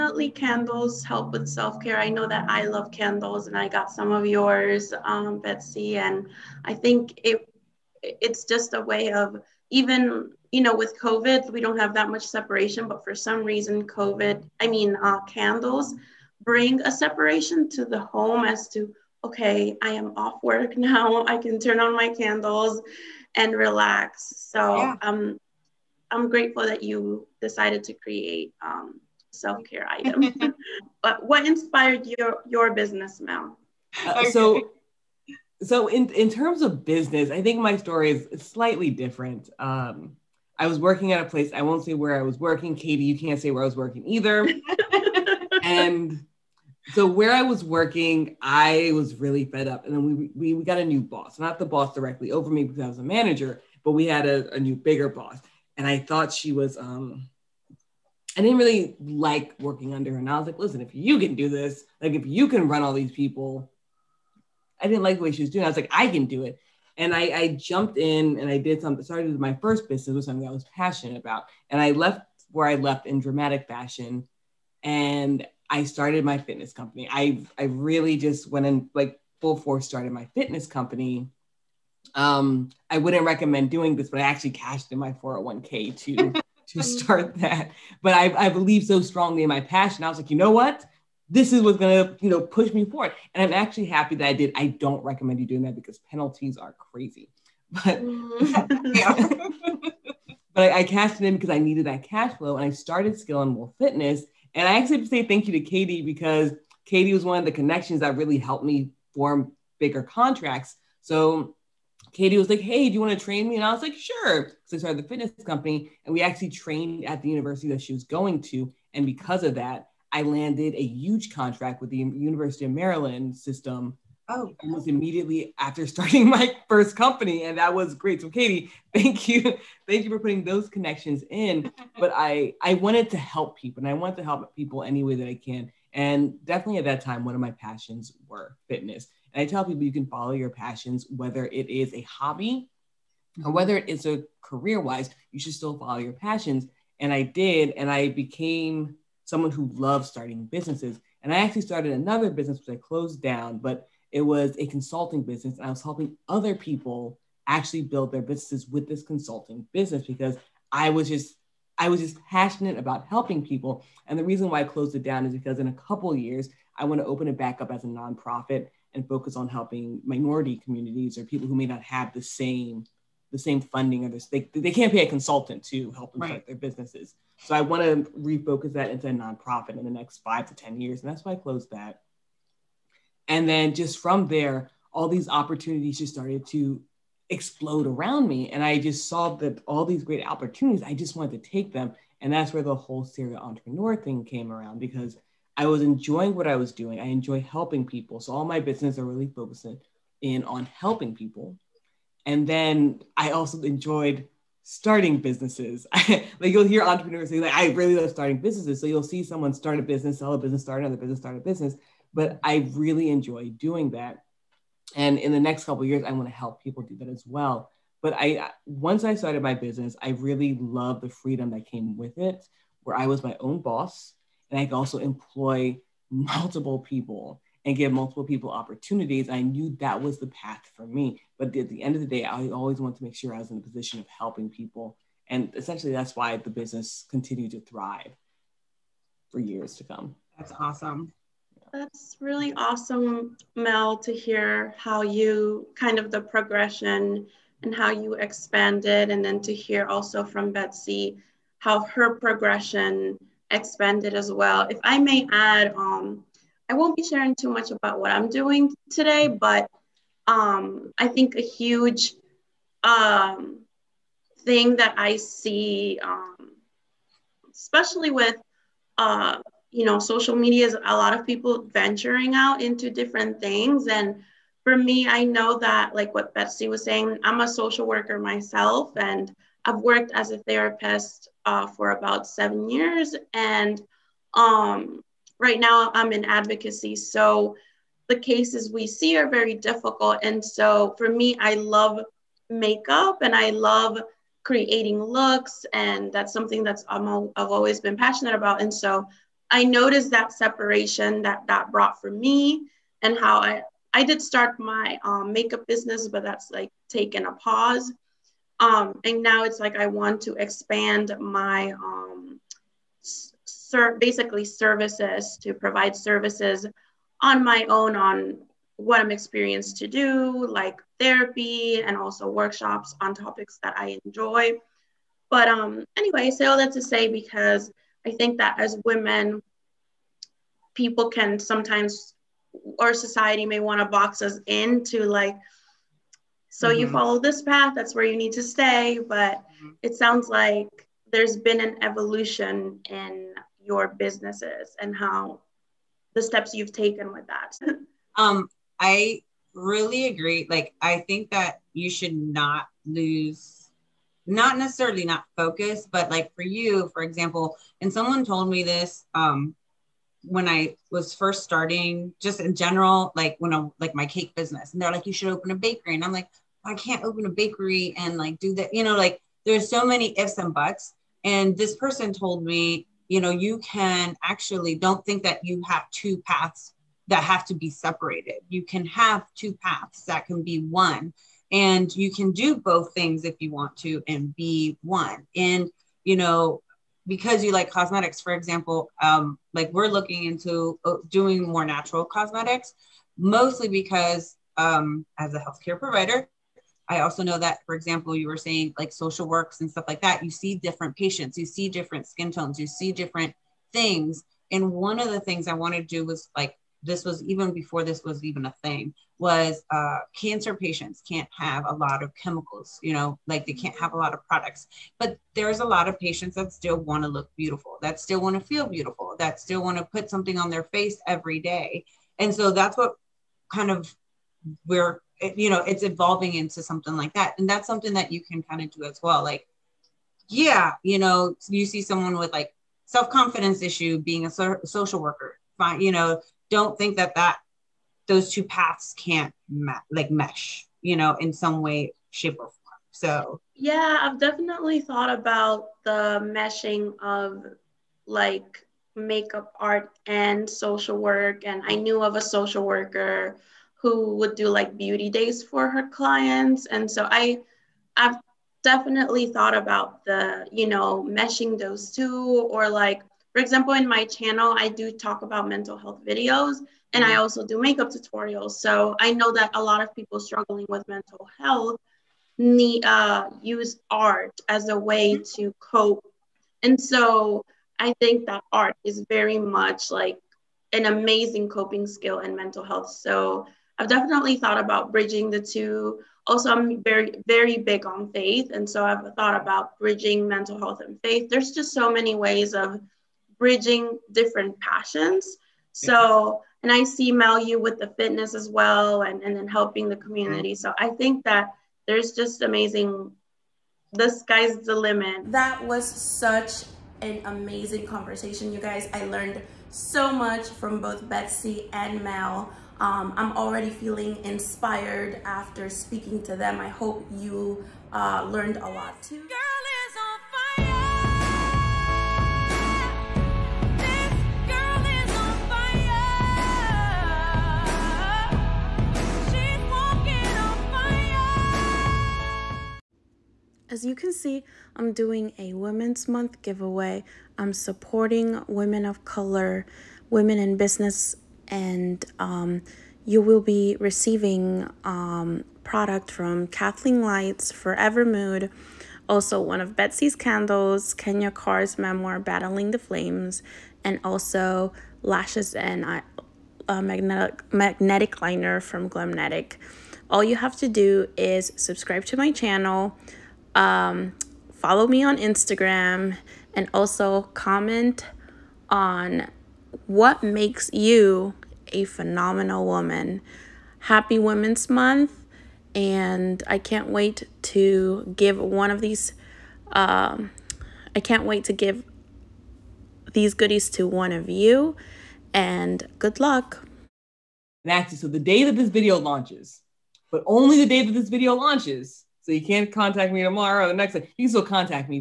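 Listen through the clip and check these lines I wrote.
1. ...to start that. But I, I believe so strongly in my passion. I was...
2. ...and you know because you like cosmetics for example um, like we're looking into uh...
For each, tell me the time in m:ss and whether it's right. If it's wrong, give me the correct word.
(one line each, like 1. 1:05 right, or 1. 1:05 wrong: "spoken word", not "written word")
1. 1:26 right
2. 6:25 right.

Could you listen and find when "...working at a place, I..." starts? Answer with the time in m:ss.
0:40.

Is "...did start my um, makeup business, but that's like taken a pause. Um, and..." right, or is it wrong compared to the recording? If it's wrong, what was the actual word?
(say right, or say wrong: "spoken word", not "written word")
right.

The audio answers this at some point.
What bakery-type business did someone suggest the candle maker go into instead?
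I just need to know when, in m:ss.
6:04.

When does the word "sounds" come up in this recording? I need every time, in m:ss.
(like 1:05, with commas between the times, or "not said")
5:39.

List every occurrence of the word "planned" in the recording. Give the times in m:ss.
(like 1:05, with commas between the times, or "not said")
not said.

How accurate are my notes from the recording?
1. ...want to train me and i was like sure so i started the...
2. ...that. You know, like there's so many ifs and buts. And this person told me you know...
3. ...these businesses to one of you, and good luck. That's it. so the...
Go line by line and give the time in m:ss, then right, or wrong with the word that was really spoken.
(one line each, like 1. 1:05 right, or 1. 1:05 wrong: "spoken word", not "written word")
1. 1:53 right
2. 6:08 right
3. 9:43 wrong: "goodies", not "businesses".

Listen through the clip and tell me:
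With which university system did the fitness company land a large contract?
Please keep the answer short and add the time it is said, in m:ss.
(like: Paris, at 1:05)
University of Maryland, at 2:01.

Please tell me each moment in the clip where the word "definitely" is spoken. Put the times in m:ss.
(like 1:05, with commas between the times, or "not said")
2:16, 7:24, 7:38, 8:03.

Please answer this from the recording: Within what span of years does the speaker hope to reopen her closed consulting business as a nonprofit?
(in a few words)
5 to 10 years.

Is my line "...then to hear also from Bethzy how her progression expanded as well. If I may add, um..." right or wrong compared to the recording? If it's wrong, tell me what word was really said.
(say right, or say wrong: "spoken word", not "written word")
right.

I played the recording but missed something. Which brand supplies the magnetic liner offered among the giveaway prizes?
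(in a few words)
Glamnetic.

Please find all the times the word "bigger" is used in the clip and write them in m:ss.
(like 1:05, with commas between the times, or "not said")
0:54, 1:49.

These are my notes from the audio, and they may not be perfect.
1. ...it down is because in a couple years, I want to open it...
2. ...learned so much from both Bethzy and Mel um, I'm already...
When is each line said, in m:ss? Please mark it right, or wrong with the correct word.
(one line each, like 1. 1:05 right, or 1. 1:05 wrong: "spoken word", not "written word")
1. 2:44 right
2. 8:29 right.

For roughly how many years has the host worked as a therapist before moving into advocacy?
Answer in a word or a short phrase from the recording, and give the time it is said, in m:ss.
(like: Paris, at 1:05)
7, at 4:42.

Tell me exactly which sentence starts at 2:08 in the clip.
So, Katie, thank you, thank you for putting those connections in.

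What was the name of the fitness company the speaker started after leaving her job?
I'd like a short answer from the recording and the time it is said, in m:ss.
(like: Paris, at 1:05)
Skill and Wolf Fitness, at 1:43.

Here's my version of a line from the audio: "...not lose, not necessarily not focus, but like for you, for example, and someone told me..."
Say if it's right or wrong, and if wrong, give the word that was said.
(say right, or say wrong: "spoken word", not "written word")
right.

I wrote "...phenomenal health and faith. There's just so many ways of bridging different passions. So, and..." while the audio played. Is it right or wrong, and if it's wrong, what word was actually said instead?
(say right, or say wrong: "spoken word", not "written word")
wrong: "mental", not "phenomenal".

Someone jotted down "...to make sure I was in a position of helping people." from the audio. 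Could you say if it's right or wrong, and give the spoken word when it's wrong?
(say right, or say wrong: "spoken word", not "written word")
right.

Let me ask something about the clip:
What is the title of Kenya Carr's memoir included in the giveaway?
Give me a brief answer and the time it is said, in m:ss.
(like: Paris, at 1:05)
Battling the Flames, at 9:12.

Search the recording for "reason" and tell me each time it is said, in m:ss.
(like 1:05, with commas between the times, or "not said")
0:13, 2:44.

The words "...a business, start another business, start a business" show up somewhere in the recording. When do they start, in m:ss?
3:30.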